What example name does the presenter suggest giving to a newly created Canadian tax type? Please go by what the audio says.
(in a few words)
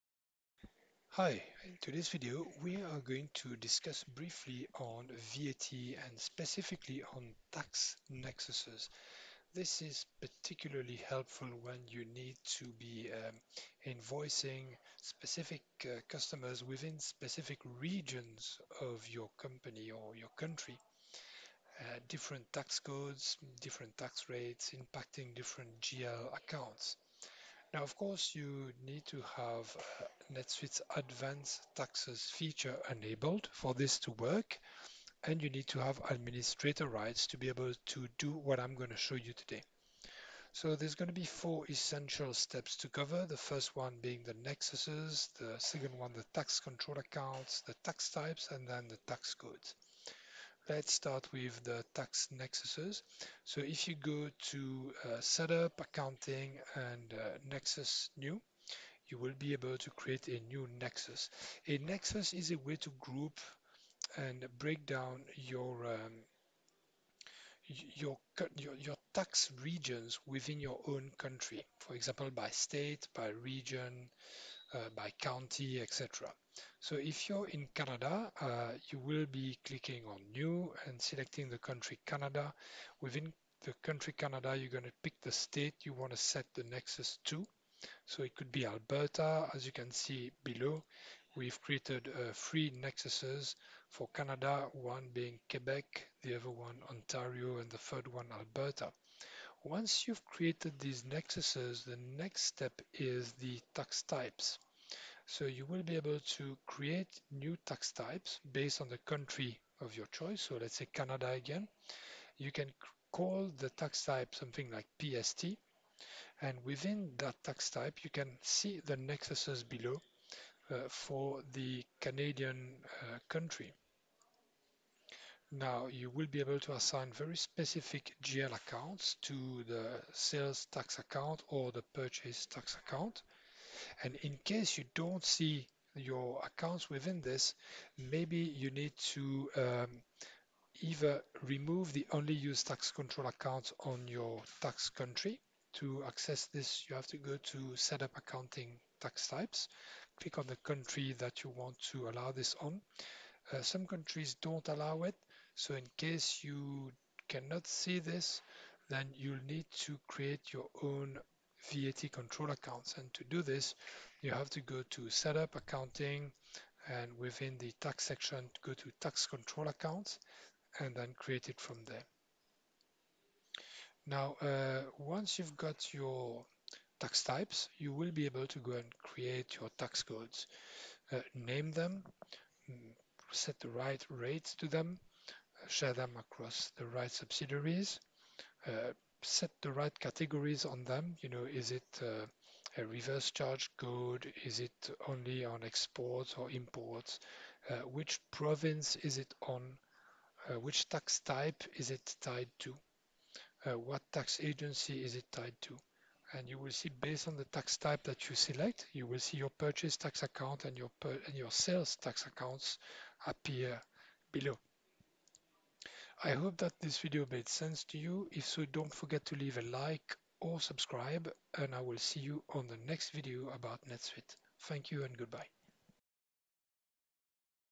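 PST.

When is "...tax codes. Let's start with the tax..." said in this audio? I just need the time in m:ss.
0:49.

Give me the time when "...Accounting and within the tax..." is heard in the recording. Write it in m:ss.
2:45.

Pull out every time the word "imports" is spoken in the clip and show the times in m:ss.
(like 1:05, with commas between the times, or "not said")
3:16.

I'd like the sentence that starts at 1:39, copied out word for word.
Once you've created these nexuses, the next step is the tax types.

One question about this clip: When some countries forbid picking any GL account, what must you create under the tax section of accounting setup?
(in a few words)
VAT control accounts.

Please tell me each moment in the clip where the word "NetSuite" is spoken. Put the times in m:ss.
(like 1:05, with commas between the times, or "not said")
0:30, 3:43.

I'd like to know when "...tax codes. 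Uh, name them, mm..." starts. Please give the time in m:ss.
2:59.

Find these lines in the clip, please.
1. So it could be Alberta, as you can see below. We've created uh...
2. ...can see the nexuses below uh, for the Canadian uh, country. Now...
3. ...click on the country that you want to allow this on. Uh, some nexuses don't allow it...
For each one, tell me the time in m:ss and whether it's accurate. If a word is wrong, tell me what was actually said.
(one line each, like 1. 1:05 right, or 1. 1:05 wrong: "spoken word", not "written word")
1. 1:28 right
2. 1:58 right
3. 2:30 wrong: "countries", not "nexuses".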